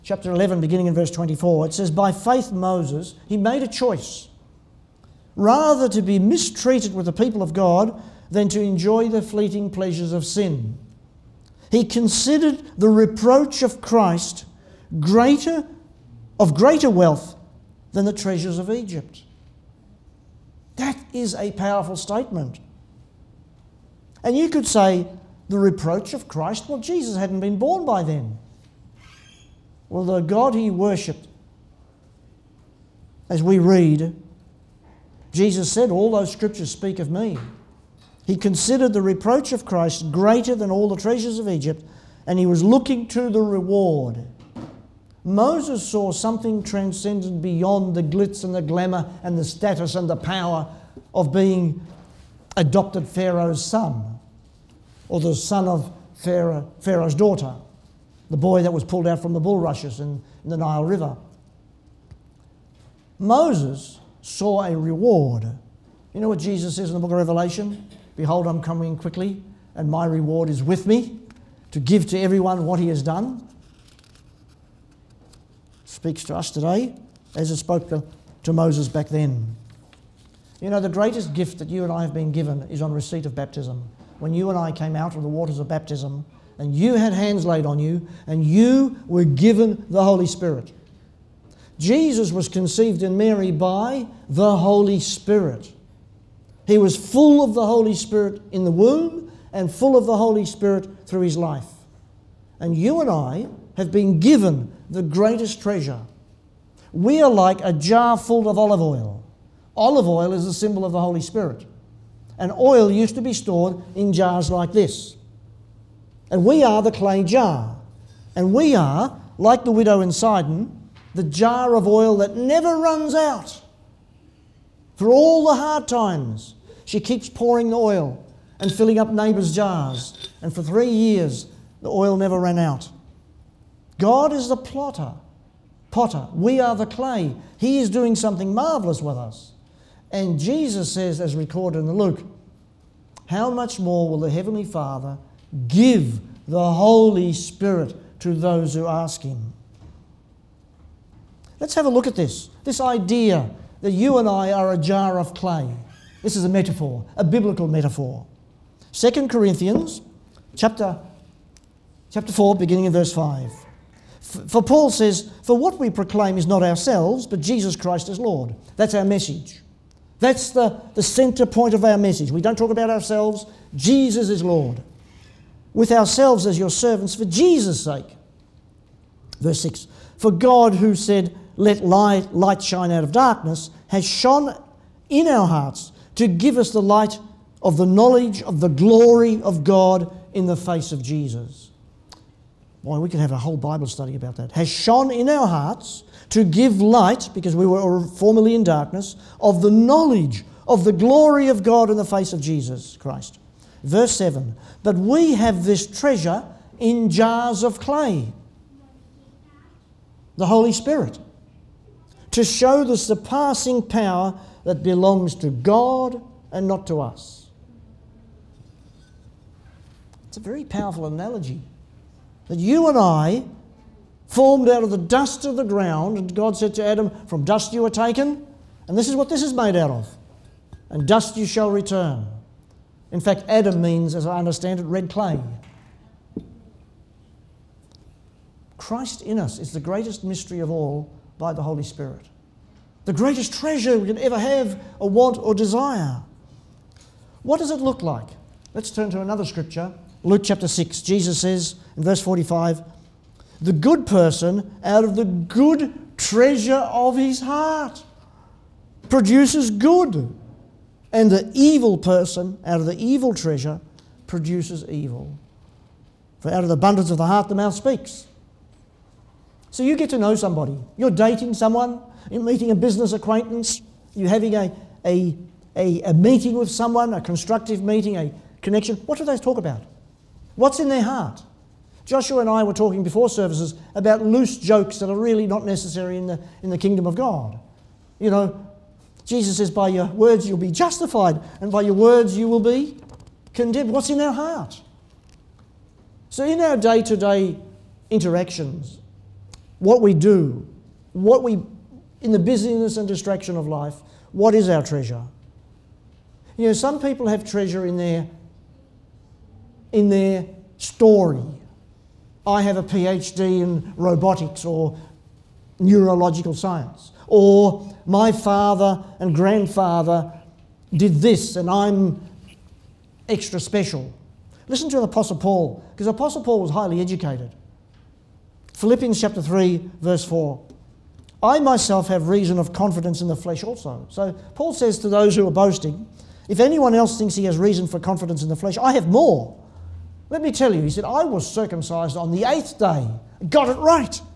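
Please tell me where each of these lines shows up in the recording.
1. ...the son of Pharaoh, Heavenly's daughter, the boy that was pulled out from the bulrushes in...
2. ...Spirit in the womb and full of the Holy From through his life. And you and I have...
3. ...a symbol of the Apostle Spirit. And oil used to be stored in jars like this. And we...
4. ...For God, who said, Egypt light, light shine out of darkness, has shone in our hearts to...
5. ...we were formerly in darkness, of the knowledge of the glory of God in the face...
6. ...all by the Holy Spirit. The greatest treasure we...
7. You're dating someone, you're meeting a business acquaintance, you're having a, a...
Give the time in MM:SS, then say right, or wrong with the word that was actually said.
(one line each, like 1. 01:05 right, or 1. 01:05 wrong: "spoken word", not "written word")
1. 00:55 wrong: "Pharaoh", not "Heavenly"
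2. 01:37 wrong: "Spirit", not "From"
3. 01:50 wrong: "Holy", not "Apostle"
4. 03:00 wrong: "Let", not "Egypt"
5. 03:17 right
6. 04:00 right
7. 04:30 right.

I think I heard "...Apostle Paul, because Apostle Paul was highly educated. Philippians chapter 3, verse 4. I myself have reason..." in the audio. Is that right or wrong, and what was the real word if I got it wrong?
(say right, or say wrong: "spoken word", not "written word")
right.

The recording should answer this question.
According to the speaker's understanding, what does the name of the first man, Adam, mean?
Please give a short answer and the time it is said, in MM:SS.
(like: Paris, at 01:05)
Red clay, at 03:54.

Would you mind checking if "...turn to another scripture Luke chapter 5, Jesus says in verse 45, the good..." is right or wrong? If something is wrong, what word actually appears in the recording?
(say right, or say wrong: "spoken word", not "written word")
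wrong: "6", not "5".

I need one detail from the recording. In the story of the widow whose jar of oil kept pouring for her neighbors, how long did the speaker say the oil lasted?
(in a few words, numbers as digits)
3 years.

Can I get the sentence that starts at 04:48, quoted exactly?
You know, Jesus says, by your words you'll be justified, and by your words you will be condemned.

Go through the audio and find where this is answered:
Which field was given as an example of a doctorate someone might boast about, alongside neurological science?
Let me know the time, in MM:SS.
05:13.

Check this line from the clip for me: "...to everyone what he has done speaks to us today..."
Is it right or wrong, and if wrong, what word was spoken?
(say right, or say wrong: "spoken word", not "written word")
right.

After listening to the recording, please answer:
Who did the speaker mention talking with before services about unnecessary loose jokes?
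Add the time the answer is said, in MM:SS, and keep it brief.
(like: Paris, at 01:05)
Joshua, at 04:42.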